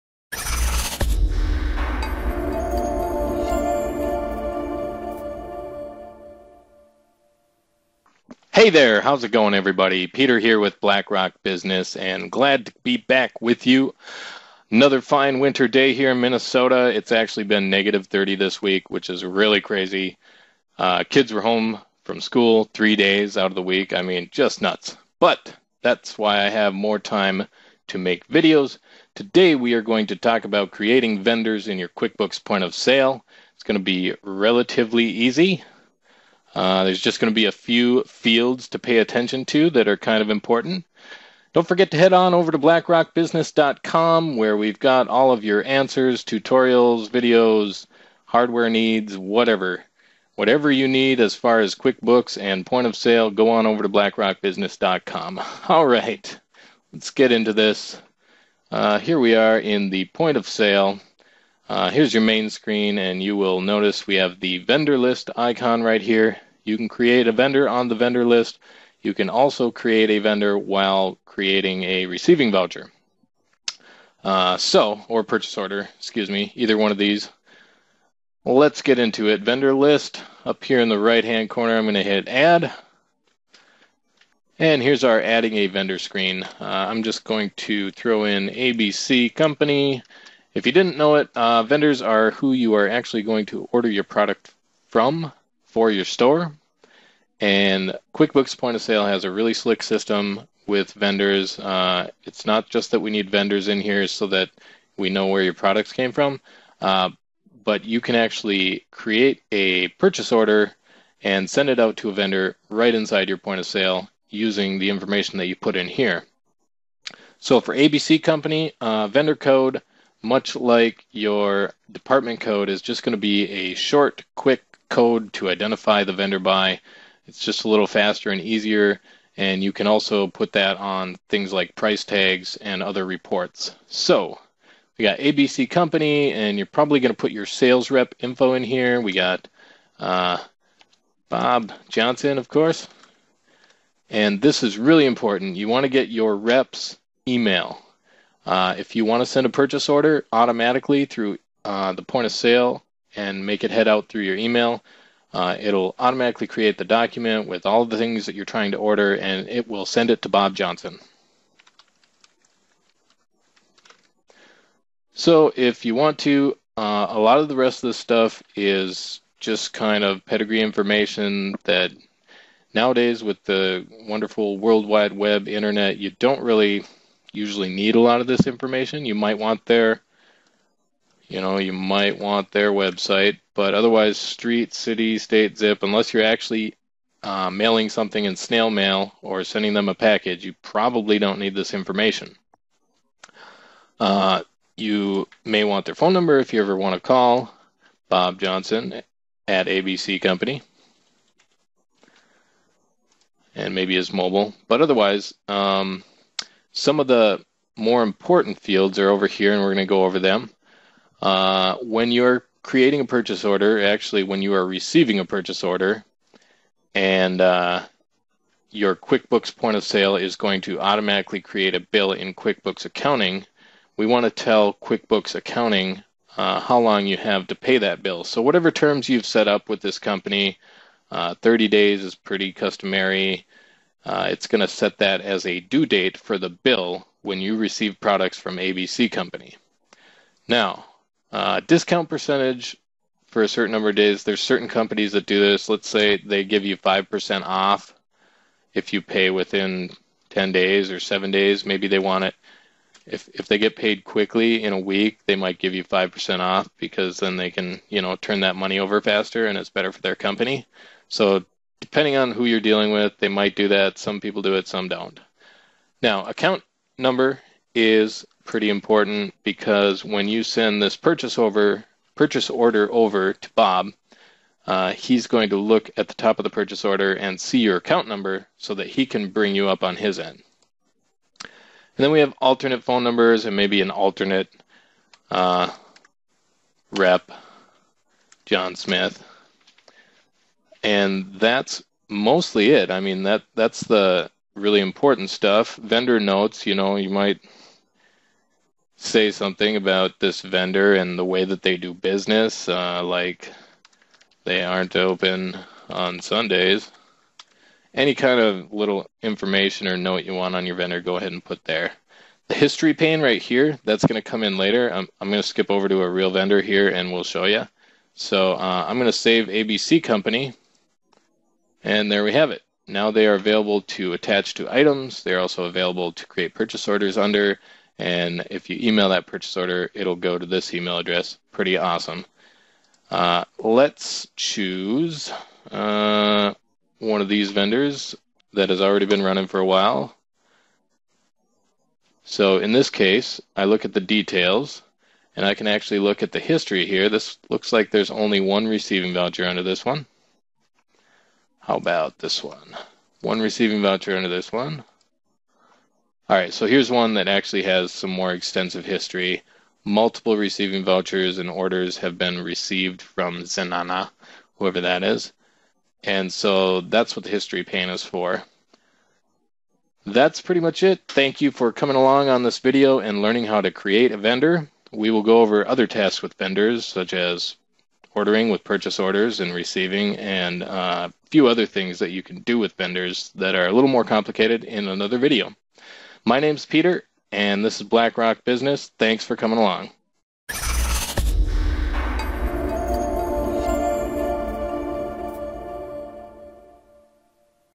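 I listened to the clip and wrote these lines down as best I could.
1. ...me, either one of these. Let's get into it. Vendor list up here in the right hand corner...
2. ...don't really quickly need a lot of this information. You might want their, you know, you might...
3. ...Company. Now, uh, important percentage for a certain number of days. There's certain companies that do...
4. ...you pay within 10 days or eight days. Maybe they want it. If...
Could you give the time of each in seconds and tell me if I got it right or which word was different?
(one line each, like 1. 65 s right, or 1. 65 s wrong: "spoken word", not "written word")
1. 76 s right
2. 176 s wrong: "usually", not "quickly"
3. 239 s wrong: "discount", not "important"
4. 248 s wrong: "seven", not "eight".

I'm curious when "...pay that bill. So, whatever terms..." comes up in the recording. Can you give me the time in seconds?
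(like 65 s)
227 s.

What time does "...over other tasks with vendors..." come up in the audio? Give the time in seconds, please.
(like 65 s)
375 s.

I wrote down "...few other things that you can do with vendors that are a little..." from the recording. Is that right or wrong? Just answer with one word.
right.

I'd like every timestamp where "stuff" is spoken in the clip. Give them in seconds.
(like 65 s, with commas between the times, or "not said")
167 s, 295 s.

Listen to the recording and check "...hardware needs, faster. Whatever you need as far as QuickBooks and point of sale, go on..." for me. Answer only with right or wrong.
wrong.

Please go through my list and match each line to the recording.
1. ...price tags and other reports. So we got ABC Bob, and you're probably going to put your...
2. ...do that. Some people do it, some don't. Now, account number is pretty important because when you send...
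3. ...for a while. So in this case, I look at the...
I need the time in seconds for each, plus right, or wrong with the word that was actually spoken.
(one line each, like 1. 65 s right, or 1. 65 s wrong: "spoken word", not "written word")
1. 131 s wrong: "Company", not "Bob"
2. 263 s right
3. 339 s right.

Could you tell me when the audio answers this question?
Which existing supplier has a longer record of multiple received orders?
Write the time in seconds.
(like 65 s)
363 s.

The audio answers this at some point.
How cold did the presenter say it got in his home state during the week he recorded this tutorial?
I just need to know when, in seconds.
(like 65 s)
17 s.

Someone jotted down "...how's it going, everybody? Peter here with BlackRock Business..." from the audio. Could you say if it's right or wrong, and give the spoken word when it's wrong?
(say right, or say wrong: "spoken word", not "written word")
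right.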